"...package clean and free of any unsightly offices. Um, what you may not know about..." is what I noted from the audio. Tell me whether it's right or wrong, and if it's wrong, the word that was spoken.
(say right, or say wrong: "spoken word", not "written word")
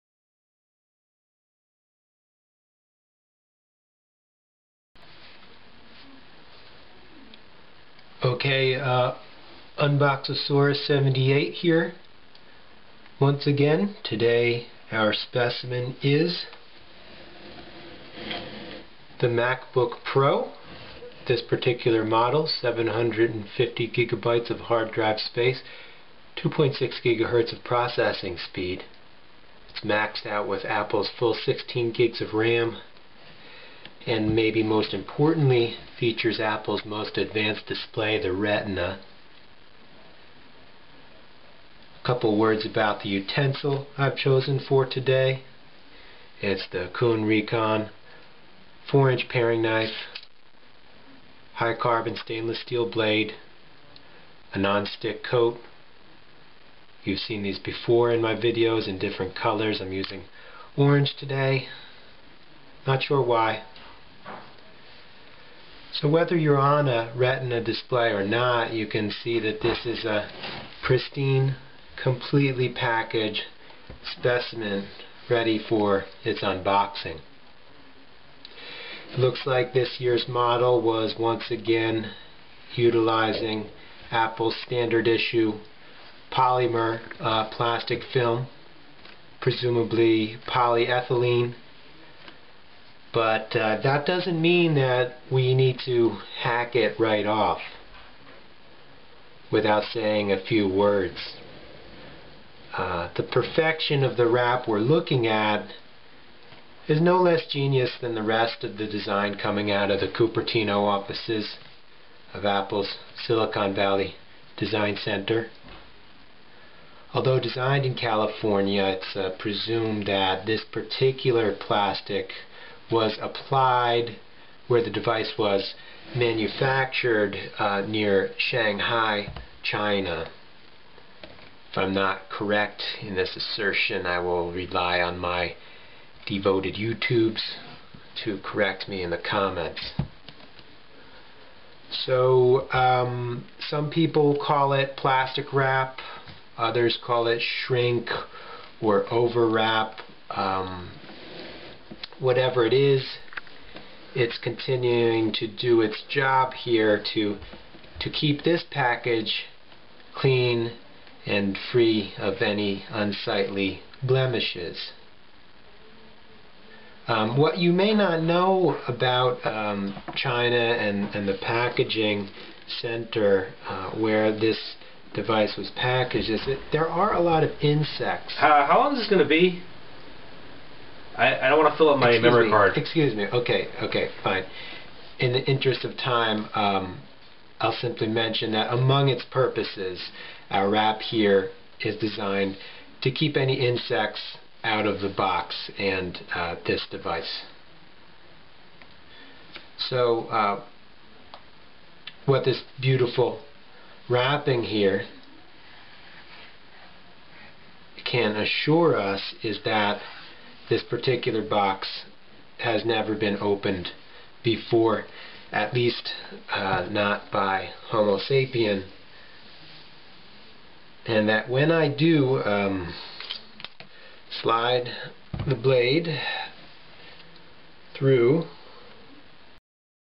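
wrong: "blemishes", not "offices".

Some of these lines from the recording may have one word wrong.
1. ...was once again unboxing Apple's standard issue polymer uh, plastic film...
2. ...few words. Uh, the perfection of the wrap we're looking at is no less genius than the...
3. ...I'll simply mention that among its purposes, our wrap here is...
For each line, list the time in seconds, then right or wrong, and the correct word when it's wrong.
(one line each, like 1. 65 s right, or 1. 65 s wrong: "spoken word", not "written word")
1. 80 s wrong: "utilizing", not "unboxing"
2. 100 s right
3. 187 s right.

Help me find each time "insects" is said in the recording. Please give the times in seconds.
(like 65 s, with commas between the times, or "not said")
177 s, 193 s.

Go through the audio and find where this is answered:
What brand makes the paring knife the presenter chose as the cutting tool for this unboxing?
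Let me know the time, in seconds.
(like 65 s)
46 s.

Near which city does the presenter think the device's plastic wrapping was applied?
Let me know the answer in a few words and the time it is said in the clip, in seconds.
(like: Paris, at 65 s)
Shanghai, at 128 s.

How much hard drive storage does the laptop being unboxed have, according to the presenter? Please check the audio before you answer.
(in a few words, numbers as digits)
750 gigabytes.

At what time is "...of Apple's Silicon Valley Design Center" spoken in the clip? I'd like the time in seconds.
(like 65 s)
112 s.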